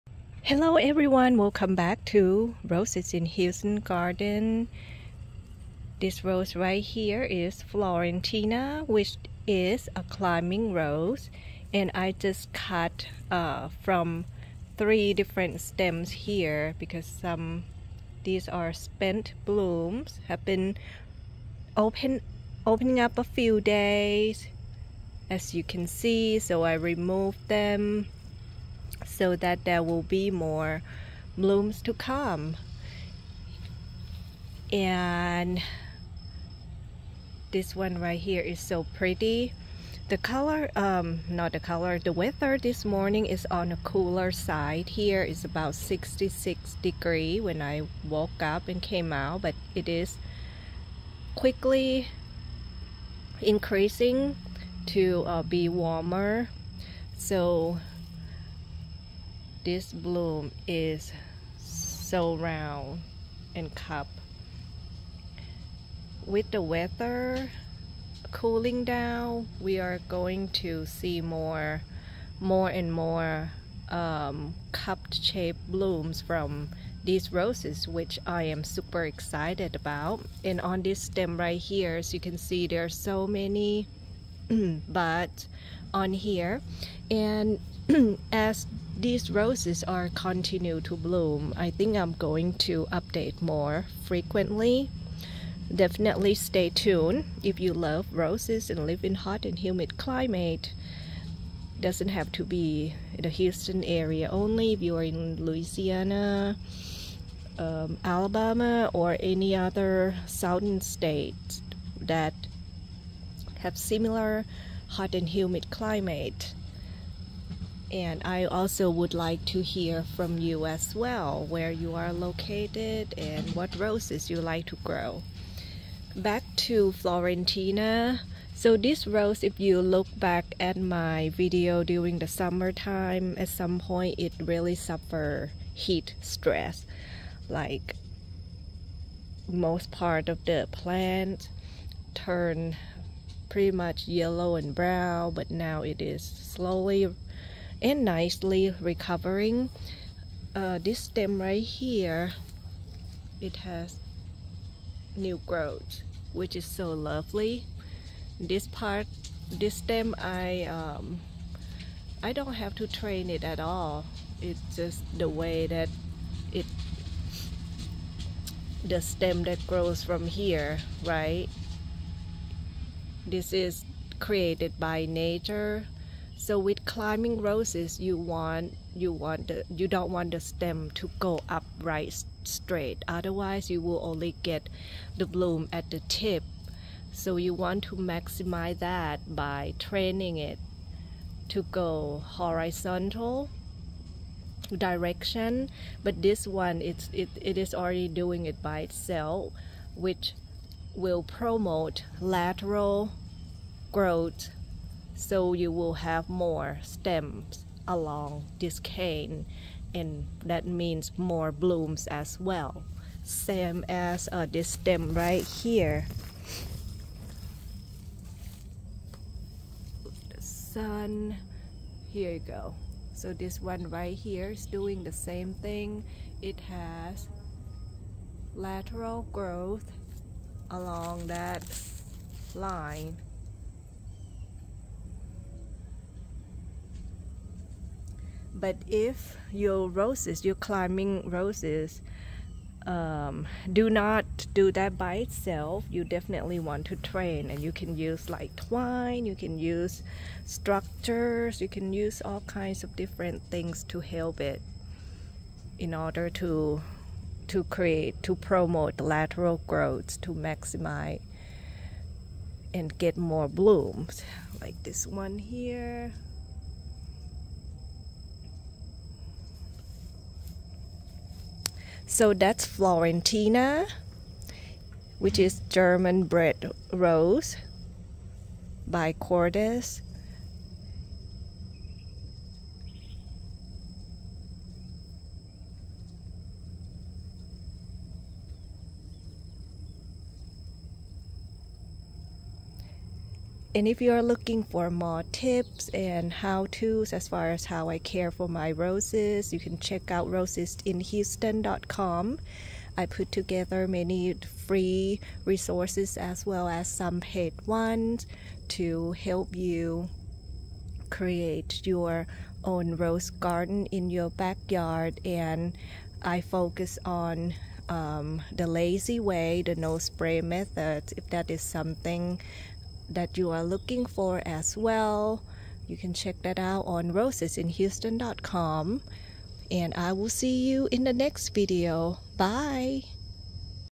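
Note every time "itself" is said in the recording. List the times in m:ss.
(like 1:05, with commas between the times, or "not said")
3:18, 4:05.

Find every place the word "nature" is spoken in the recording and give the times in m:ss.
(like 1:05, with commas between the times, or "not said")
2:55.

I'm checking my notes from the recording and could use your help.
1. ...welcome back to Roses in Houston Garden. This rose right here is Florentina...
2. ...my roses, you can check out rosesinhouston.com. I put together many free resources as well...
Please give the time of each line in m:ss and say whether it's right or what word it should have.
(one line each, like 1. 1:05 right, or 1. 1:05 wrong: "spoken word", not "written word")
1. 0:01 right
2. 4:58 right.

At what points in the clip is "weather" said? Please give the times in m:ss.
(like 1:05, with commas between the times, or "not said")
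0:42, 1:06.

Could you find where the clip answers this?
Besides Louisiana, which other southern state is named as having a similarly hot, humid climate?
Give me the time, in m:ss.
1:48.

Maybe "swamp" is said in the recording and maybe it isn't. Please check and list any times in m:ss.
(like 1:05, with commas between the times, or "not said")
not said.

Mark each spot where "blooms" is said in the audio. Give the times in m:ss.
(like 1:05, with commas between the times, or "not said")
0:19, 0:31, 0:59, 1:15, 1:30, 3:05, 3:31, 4:23.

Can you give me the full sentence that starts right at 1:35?
Definitely stay tuned if you love roses and live in hot and humid climate.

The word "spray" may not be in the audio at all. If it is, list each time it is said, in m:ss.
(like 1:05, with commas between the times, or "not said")
5:19.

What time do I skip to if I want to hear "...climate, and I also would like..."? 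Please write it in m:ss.
1:55.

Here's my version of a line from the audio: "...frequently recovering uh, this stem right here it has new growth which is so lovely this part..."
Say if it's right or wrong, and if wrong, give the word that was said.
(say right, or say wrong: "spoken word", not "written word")
wrong: "nicely", not "frequently".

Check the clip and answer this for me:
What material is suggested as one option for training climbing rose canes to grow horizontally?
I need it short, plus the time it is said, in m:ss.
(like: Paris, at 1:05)
Twine, at 4:08.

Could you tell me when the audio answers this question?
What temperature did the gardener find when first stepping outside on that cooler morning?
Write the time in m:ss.
0:45.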